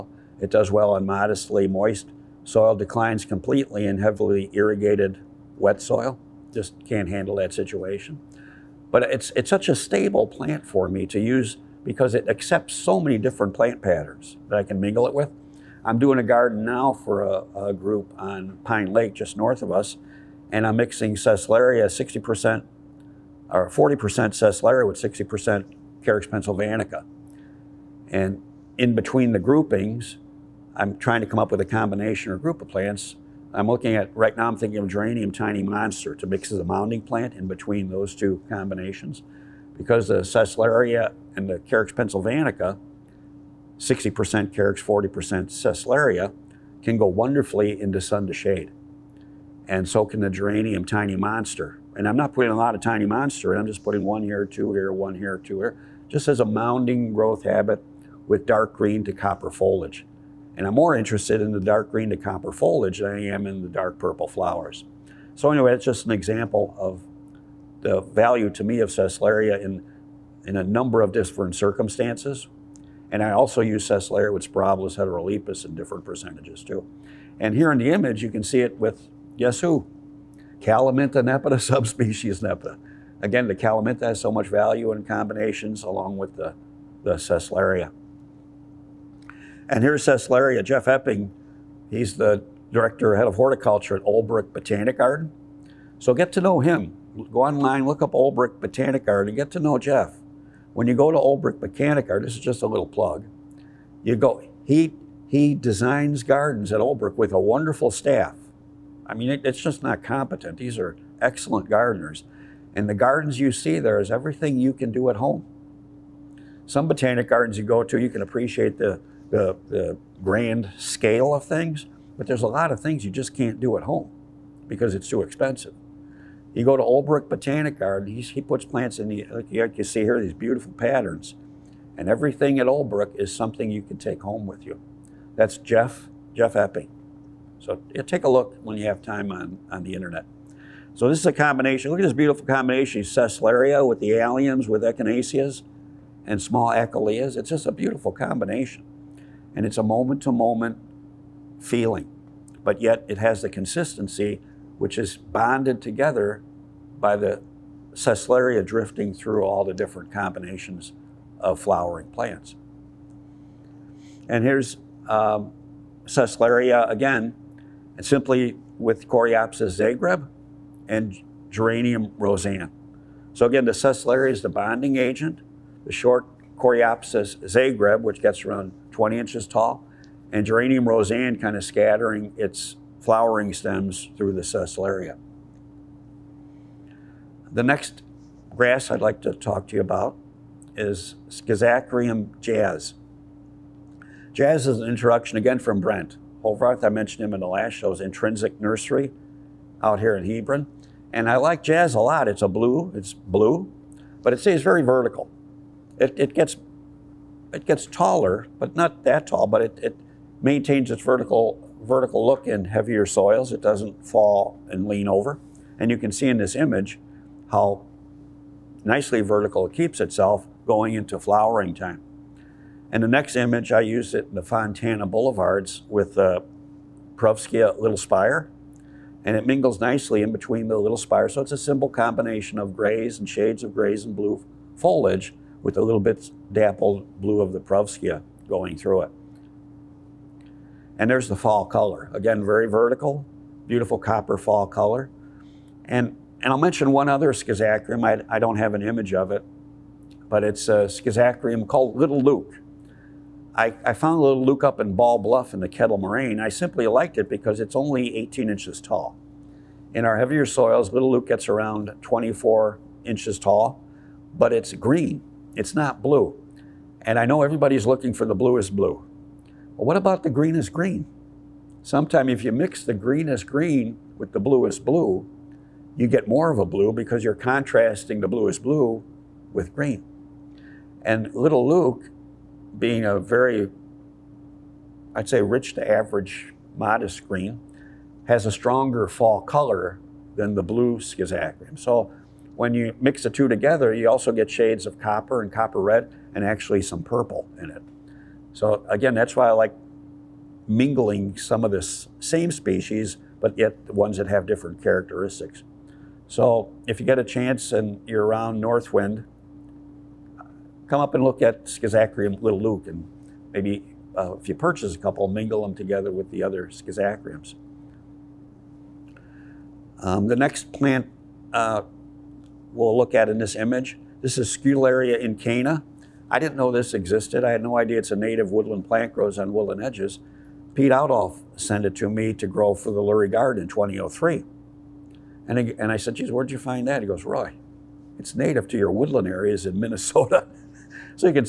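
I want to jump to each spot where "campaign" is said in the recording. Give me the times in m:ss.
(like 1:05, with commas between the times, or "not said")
not said.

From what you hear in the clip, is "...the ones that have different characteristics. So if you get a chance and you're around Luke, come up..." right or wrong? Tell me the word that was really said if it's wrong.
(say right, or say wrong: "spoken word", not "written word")
wrong: "Northwind", not "Luke".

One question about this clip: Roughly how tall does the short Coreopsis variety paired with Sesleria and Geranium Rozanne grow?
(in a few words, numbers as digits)
20 inches.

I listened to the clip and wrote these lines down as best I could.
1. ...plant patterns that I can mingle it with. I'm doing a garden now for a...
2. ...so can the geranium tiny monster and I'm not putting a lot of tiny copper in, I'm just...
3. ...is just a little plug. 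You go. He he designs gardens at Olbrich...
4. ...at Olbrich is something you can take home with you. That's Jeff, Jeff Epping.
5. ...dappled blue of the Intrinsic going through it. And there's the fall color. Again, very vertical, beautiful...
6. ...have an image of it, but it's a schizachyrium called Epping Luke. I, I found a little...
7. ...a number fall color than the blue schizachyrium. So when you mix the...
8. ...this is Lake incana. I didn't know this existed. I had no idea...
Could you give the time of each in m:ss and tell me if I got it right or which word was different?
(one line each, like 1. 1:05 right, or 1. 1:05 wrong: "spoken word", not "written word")
1. 0:13 right
2. 0:49 wrong: "monster", not "copper"
3. 1:42 right
4. 2:12 right
5. 3:56 wrong: "Perovskia", not "Intrinsic"
6. 4:08 wrong: "Little", not "Epping"
7. 4:48 wrong: "stronger", not "number"
8. 5:24 wrong: "Scutellaria", not "Lake".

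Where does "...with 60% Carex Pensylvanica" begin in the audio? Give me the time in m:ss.
0:24.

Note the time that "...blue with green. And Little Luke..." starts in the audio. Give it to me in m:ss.
4:38.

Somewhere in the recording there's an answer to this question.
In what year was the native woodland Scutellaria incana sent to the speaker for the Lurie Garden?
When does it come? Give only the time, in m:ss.
5:33.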